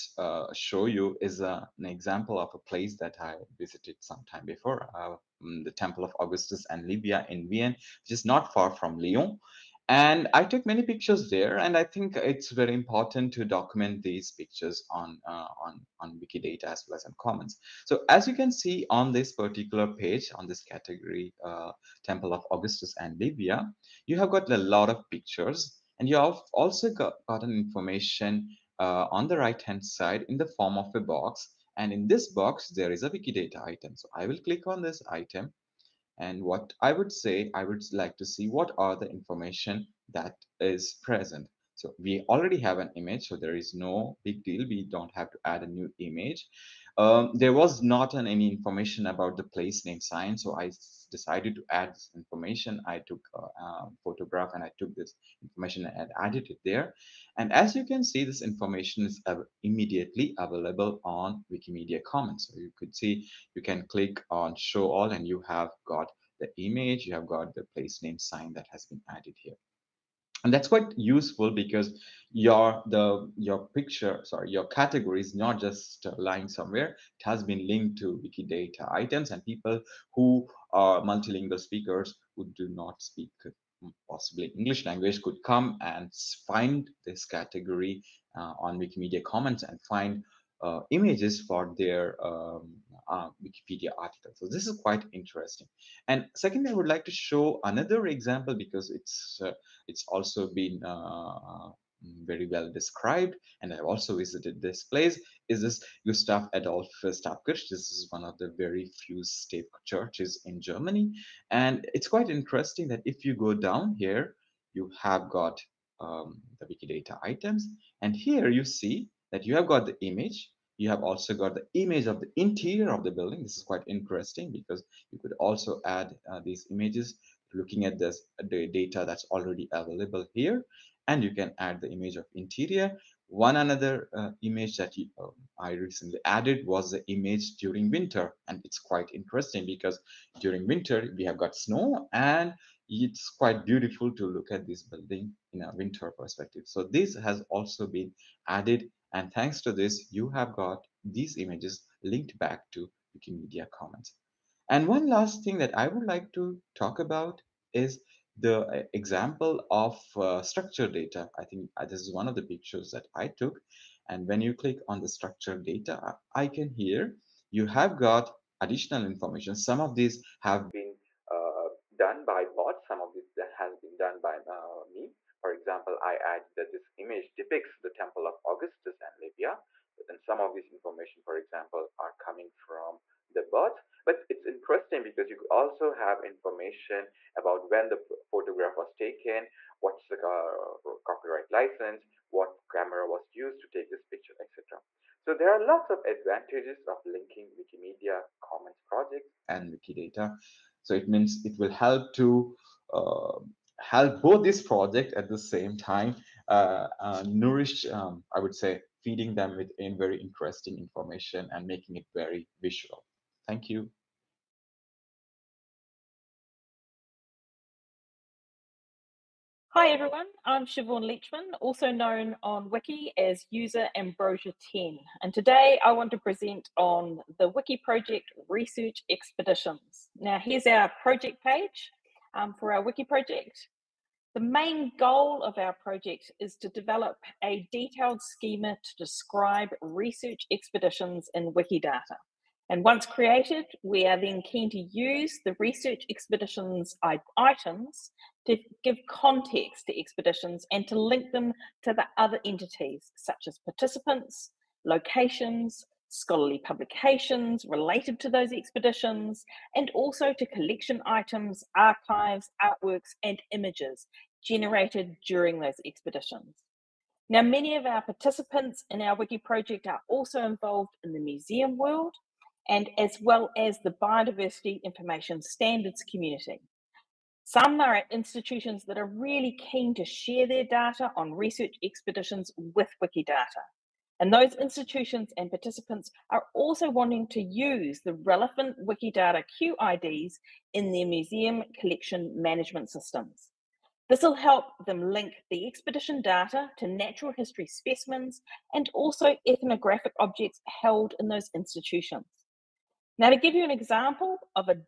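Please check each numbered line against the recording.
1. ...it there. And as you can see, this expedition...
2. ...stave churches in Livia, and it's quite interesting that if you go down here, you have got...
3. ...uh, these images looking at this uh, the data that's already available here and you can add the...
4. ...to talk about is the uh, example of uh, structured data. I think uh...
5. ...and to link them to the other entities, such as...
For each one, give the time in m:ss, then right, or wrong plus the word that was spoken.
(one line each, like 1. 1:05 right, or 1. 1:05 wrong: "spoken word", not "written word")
1. 0:56 wrong: "information", not "expedition"
2. 1:49 wrong: "Germany", not "Livia"
3. 2:06 right
4. 2:36 right
5. 4:10 right.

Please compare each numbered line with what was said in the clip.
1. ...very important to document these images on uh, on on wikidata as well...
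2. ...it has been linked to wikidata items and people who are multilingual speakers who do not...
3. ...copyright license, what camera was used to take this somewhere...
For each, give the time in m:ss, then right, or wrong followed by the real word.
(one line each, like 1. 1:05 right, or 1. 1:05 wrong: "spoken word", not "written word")
1. 0:12 wrong: "pictures", not "images"
2. 1:17 right
3. 3:11 wrong: "picture", not "somewhere".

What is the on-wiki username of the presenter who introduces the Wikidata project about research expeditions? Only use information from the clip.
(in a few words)
Ambrosia10.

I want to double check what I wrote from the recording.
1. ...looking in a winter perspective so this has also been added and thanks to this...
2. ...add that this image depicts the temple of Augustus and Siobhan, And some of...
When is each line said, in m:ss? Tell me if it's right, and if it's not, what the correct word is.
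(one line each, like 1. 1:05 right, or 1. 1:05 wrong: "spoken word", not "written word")
1. 2:24 wrong: "building", not "looking"
2. 2:56 wrong: "Livia", not "Siobhan".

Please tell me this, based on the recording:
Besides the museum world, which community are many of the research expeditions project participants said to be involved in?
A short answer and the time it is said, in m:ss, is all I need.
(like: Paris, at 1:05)
biodiversity information standards, at 4:34.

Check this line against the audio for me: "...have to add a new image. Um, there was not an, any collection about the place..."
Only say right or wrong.
wrong.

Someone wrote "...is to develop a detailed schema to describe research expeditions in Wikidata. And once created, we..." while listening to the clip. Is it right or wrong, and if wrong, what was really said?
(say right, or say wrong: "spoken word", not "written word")
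right.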